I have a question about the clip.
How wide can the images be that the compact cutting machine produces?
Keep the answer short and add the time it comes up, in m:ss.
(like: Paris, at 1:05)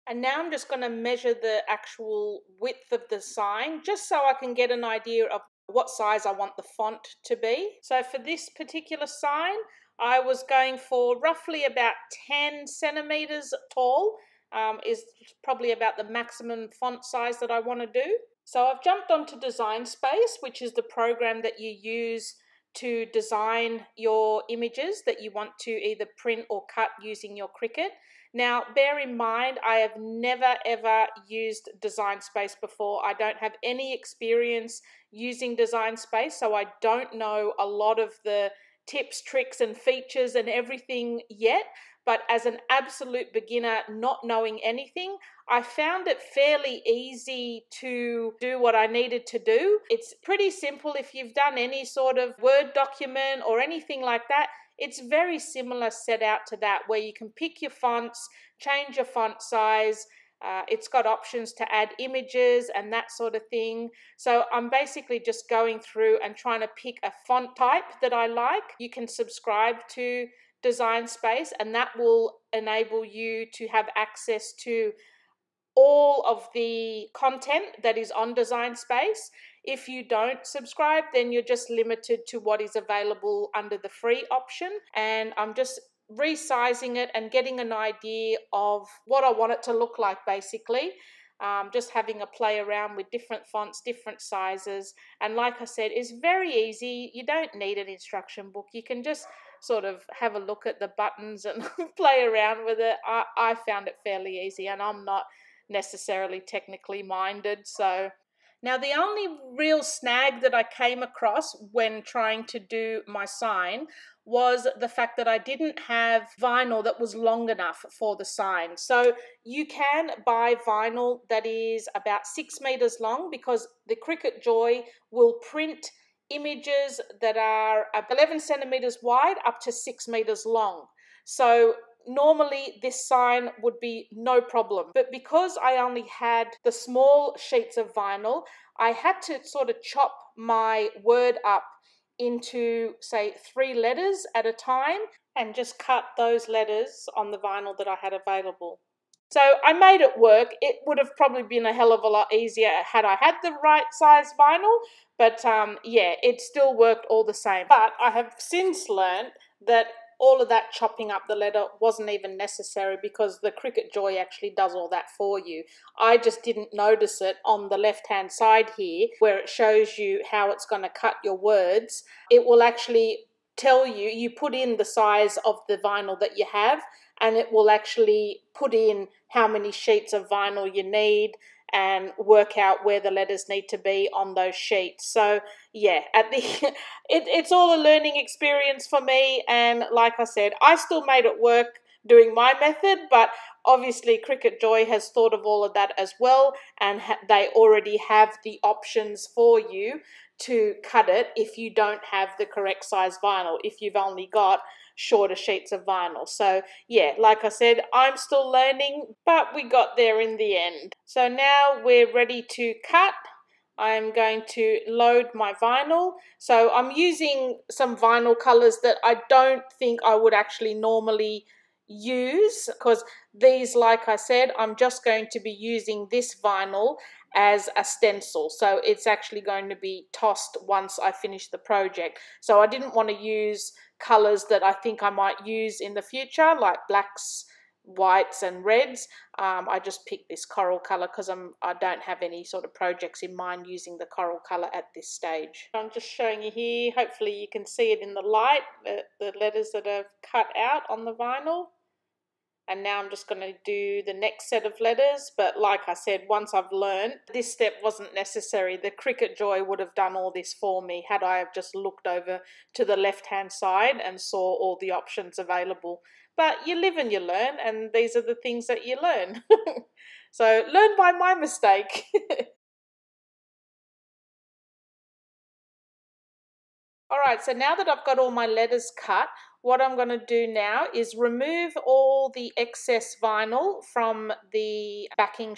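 11 centimeters, at 2:08.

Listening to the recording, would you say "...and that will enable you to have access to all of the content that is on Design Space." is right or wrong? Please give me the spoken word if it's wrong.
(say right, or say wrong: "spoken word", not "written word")
right.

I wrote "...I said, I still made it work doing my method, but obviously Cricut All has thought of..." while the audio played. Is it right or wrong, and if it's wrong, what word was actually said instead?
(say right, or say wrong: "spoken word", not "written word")
wrong: "Joy", not "All".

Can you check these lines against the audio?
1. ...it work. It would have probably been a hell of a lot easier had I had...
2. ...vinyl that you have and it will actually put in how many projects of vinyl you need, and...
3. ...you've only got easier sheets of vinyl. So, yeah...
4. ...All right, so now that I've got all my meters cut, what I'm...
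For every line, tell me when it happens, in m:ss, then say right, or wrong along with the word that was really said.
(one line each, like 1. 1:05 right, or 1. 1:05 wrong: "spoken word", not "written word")
1. 2:30 right
2. 2:55 wrong: "sheets", not "projects"
3. 3:23 wrong: "shorter", not "easier"
4. 4:37 wrong: "letters", not "meters".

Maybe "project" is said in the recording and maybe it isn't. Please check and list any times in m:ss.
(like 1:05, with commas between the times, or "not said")
3:51, 4:02.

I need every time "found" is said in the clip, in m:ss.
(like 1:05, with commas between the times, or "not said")
0:45, 1:43.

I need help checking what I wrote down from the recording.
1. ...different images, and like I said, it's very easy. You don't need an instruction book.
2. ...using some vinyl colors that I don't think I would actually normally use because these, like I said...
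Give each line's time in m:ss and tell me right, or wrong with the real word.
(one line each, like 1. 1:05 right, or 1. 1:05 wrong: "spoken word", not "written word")
1. 1:33 wrong: "sizes", not "images"
2. 3:36 right.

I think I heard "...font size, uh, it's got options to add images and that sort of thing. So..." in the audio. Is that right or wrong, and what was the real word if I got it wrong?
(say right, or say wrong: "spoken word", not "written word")
right.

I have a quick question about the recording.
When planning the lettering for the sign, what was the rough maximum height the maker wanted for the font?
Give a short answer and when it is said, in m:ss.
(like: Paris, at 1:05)
10 centimeters, at 0:12.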